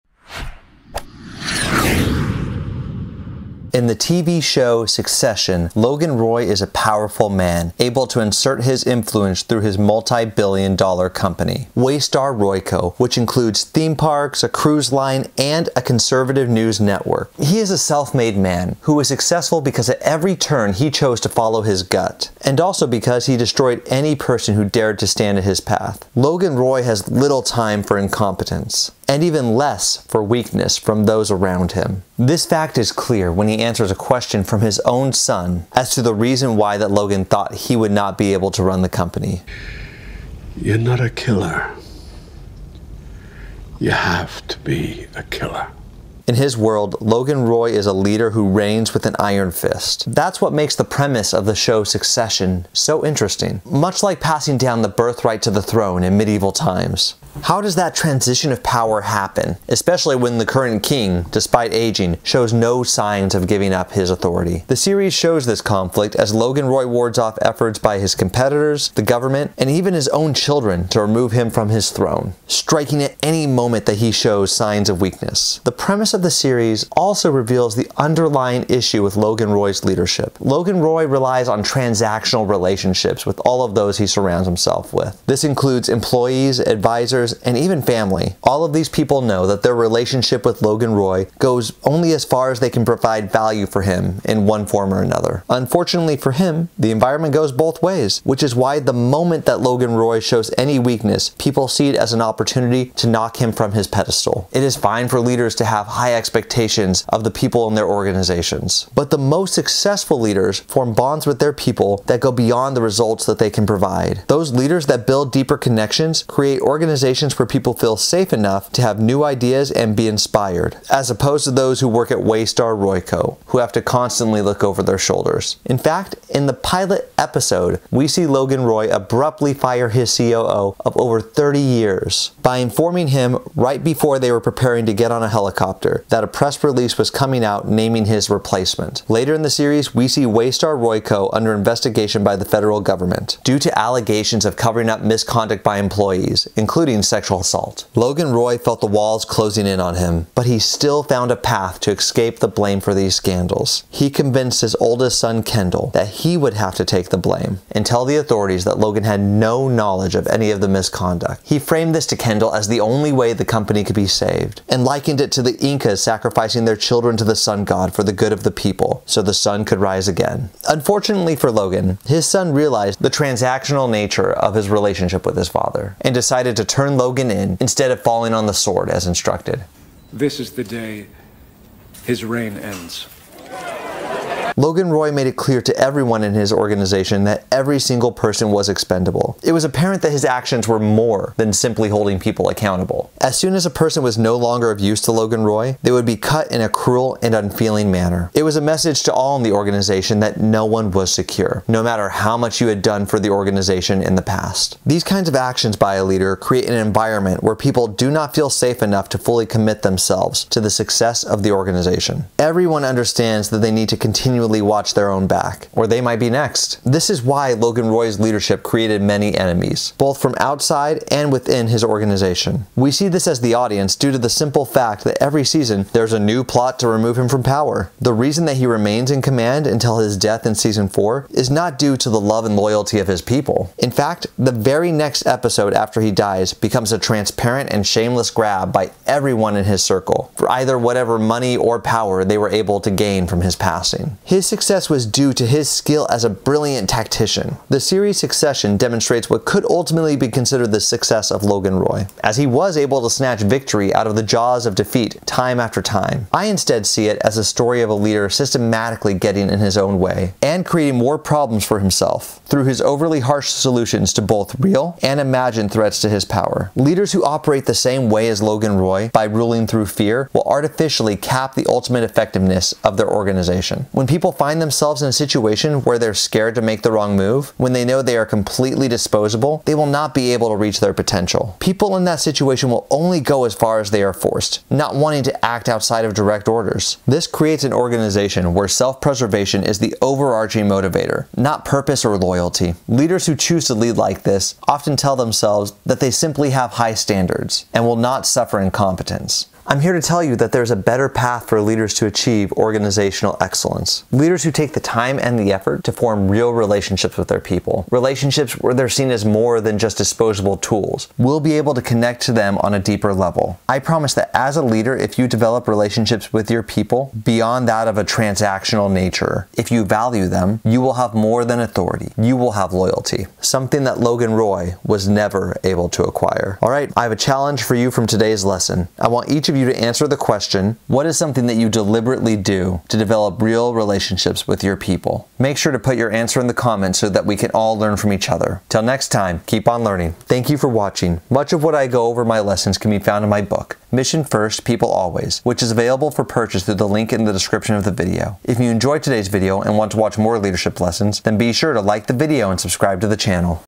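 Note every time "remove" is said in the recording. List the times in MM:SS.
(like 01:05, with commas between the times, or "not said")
01:11, 03:46.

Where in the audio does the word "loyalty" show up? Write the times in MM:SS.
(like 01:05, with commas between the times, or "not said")
03:52, 04:52, 05:22.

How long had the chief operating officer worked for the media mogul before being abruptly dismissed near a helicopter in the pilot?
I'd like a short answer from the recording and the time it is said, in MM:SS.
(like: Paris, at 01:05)
over 30 years, at 02:10.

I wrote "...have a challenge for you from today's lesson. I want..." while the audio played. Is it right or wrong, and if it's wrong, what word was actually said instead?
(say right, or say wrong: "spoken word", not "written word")
right.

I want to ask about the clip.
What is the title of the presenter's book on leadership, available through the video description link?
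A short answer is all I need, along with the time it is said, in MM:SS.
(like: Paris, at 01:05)
Mission First, People Always, at 05:43.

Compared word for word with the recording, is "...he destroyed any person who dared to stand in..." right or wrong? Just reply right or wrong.
right.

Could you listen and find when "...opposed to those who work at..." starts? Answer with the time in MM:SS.
02:01.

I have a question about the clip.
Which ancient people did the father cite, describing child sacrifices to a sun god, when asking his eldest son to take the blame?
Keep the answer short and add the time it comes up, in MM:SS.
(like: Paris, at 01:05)
Incas, at 02:45.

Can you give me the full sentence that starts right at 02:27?
Logan Roy felt the walls closing in on him, but he still found a path to escape the blame for these scandals.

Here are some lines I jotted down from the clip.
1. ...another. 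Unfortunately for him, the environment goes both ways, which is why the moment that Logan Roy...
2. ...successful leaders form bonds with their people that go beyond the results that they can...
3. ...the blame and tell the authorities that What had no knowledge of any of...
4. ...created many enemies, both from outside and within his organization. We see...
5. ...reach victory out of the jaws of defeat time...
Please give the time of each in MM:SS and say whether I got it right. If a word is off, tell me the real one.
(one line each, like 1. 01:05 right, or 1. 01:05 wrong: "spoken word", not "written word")
1. 01:35 right
2. 01:49 right
3. 02:37 wrong: "Logan", not "What"
4. 03:38 right
5. 04:13 wrong: "snatch", not "reach".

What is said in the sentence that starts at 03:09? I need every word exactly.
It was apparent that his actions were more than simply holding people accountable.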